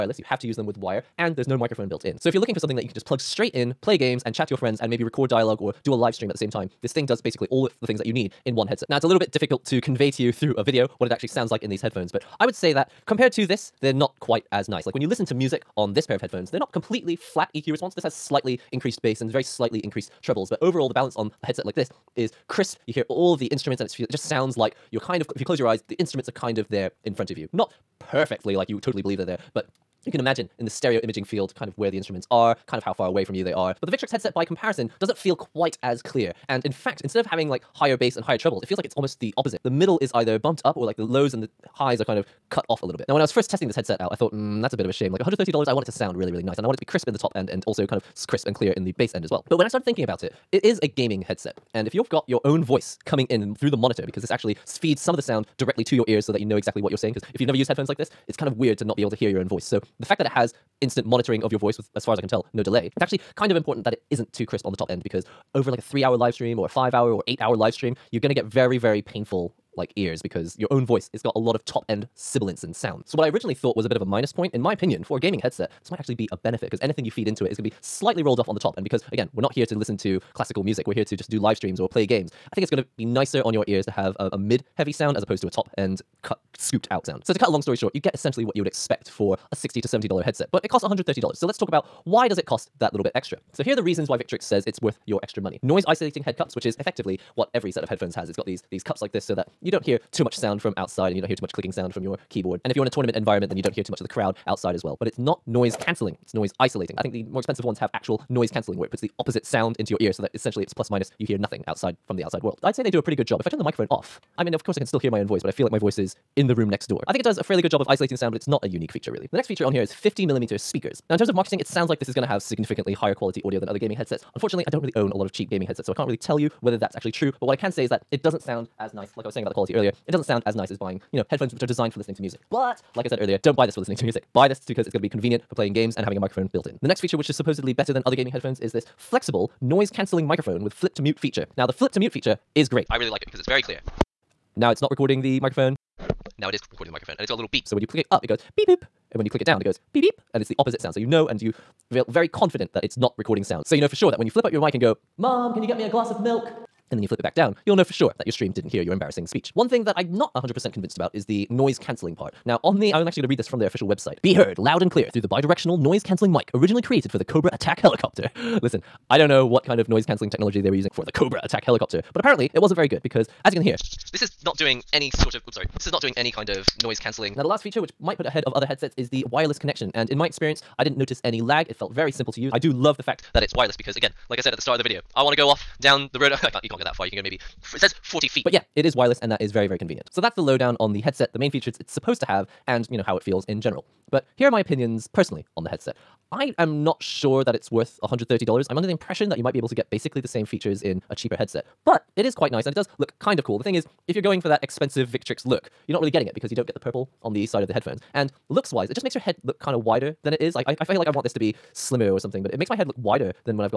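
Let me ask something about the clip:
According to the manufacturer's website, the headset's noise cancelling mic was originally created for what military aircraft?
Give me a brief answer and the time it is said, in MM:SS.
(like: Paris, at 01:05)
Cobra attack helicopter, at 02:47.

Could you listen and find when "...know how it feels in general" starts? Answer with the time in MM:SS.
03:12.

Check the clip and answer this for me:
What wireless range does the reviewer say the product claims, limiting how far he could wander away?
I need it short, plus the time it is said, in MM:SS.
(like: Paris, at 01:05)
40 feet, at 03:08.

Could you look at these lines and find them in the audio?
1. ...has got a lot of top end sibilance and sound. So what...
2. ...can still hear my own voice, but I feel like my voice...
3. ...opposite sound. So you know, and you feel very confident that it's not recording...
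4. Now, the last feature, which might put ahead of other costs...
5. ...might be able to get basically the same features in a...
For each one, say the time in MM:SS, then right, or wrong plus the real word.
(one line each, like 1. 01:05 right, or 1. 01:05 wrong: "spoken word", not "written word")
1. 01:11 right
2. 01:54 right
3. 02:30 right
4. 02:57 wrong: "headsets", not "costs"
5. 03:19 right.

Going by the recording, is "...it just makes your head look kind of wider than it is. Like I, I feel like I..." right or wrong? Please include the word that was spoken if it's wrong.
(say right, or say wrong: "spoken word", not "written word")
right.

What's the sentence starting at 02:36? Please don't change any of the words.
and then you flip it back down, you'll know for sure that your stream didn't hear your embarrassing speech.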